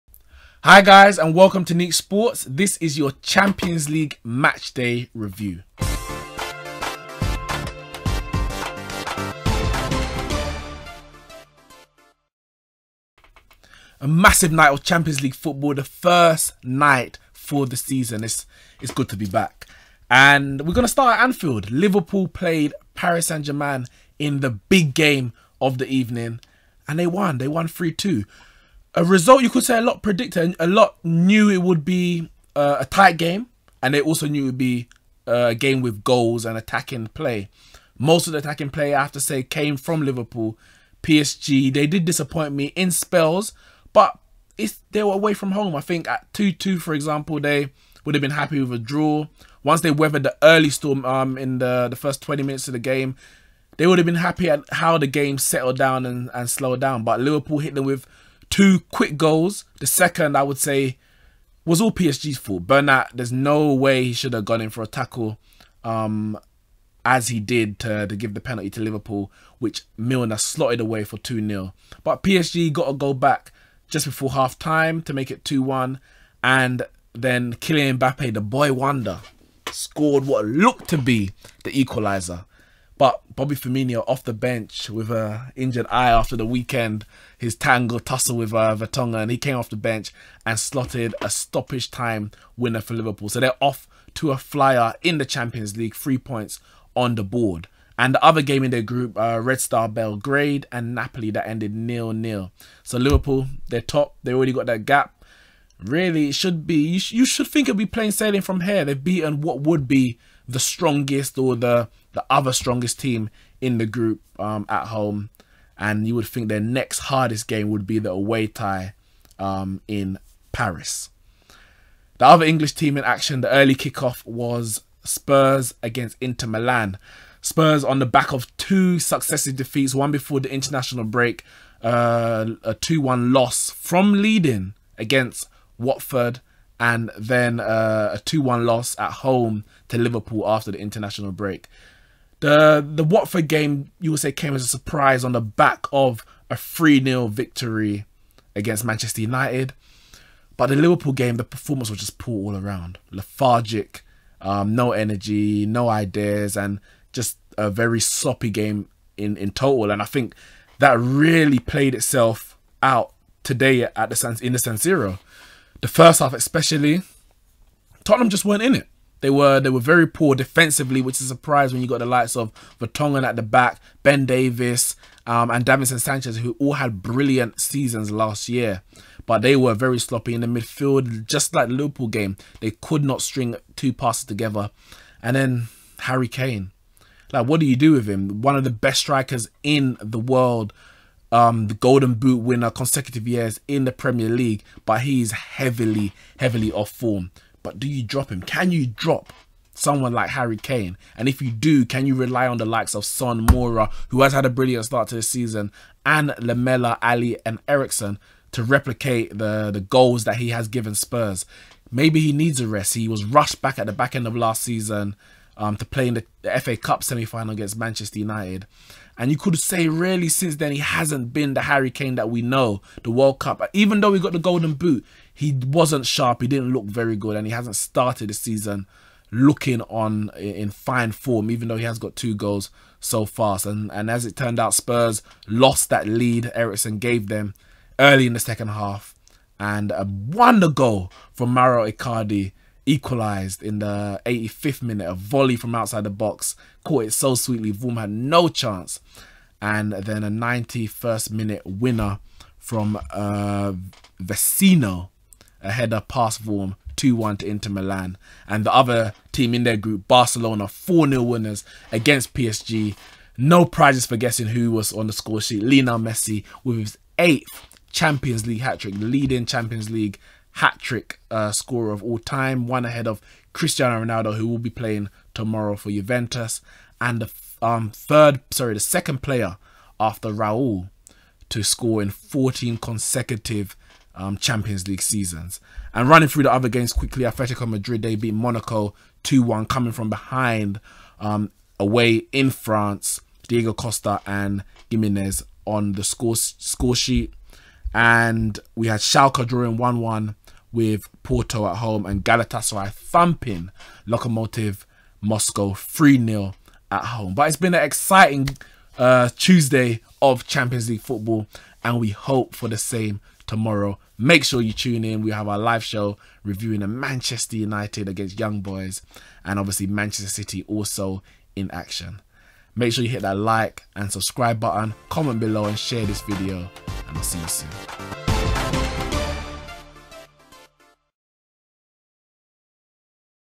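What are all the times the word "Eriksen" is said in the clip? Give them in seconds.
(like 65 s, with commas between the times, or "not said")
207 s, 236 s.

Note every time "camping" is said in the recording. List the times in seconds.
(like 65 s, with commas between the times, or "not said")
not said.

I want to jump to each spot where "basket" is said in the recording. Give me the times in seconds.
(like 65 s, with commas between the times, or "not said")
not said.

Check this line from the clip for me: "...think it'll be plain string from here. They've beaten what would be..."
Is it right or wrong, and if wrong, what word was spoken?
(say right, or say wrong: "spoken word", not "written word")
wrong: "sailing", not "string".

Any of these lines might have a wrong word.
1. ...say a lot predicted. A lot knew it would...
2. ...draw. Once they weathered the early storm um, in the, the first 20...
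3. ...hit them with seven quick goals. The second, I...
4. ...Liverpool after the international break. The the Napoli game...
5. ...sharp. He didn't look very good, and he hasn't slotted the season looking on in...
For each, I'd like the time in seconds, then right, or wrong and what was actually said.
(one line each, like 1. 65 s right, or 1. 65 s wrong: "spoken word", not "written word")
1. 29 s right
2. 48 s right
3. 57 s wrong: "two", not "seven"
4. 139 s wrong: "Watford", not "Napoli"
5. 226 s wrong: "started", not "slotted".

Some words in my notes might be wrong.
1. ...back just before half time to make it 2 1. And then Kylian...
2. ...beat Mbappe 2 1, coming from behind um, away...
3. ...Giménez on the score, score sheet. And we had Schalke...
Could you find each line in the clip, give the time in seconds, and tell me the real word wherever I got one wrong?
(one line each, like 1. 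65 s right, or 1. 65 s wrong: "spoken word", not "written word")
1. 73 s right
2. 288 s wrong: "Monaco", not "Mbappe"
3. 294 s right.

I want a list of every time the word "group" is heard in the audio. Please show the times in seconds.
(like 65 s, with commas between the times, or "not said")
98 s, 113 s, 259 s.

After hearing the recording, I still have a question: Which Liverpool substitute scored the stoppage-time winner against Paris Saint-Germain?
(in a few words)
Bobby Firmino.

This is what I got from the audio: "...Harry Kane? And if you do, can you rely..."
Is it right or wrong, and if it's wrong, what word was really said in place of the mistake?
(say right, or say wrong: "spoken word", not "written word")
right.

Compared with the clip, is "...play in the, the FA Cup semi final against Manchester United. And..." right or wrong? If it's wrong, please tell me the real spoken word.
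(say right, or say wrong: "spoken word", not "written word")
right.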